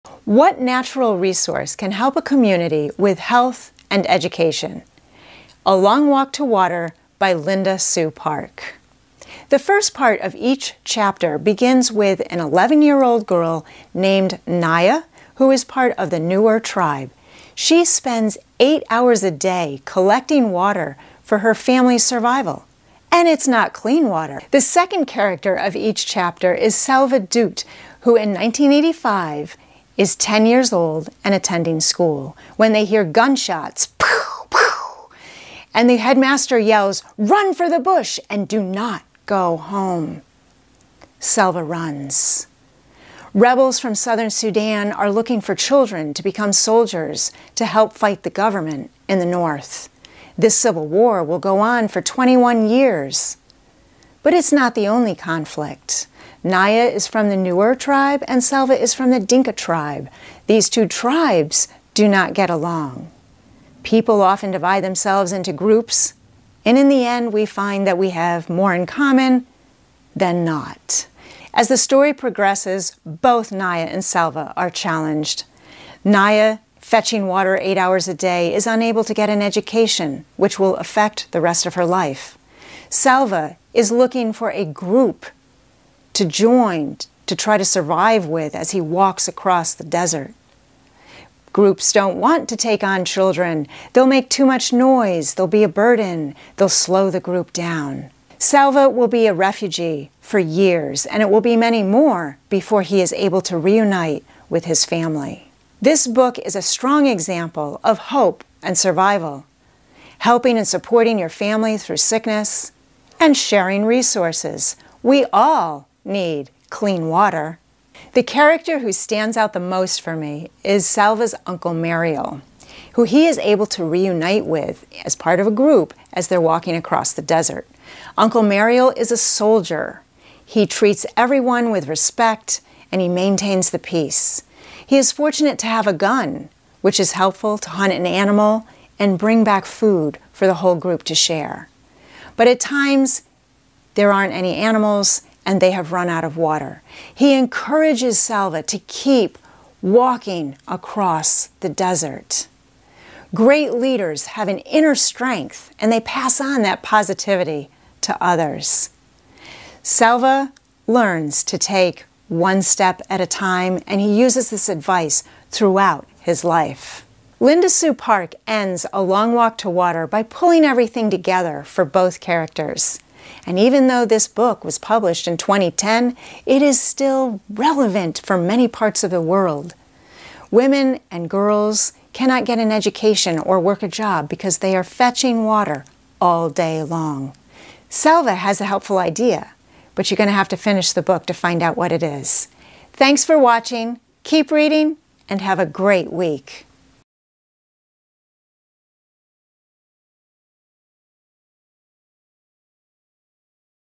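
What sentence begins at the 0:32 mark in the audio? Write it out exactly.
When they hear gunshots, pow, pow, and the headmaster yells, run for the bush and do not go home.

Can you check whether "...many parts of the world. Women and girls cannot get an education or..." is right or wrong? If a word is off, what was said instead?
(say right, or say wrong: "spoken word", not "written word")
right.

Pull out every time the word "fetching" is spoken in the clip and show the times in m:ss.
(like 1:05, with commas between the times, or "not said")
1:16, 3:04.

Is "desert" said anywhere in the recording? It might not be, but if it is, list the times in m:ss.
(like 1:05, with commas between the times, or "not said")
1:29, 2:07, 2:31.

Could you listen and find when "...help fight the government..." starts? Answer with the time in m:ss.
0:47.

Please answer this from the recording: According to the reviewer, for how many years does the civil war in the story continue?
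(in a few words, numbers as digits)
21.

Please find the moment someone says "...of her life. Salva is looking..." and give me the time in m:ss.
1:21.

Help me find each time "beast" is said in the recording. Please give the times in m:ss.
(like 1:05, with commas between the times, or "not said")
not said.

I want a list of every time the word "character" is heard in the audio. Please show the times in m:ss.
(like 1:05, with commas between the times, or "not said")
0:25, 1:58, 2:52.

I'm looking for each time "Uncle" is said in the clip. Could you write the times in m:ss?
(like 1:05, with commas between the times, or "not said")
2:01, 2:08.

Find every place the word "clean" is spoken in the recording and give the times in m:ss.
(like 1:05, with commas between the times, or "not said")
0:23, 1:56.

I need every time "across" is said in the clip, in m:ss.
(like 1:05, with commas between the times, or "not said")
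1:29, 2:06, 2:30.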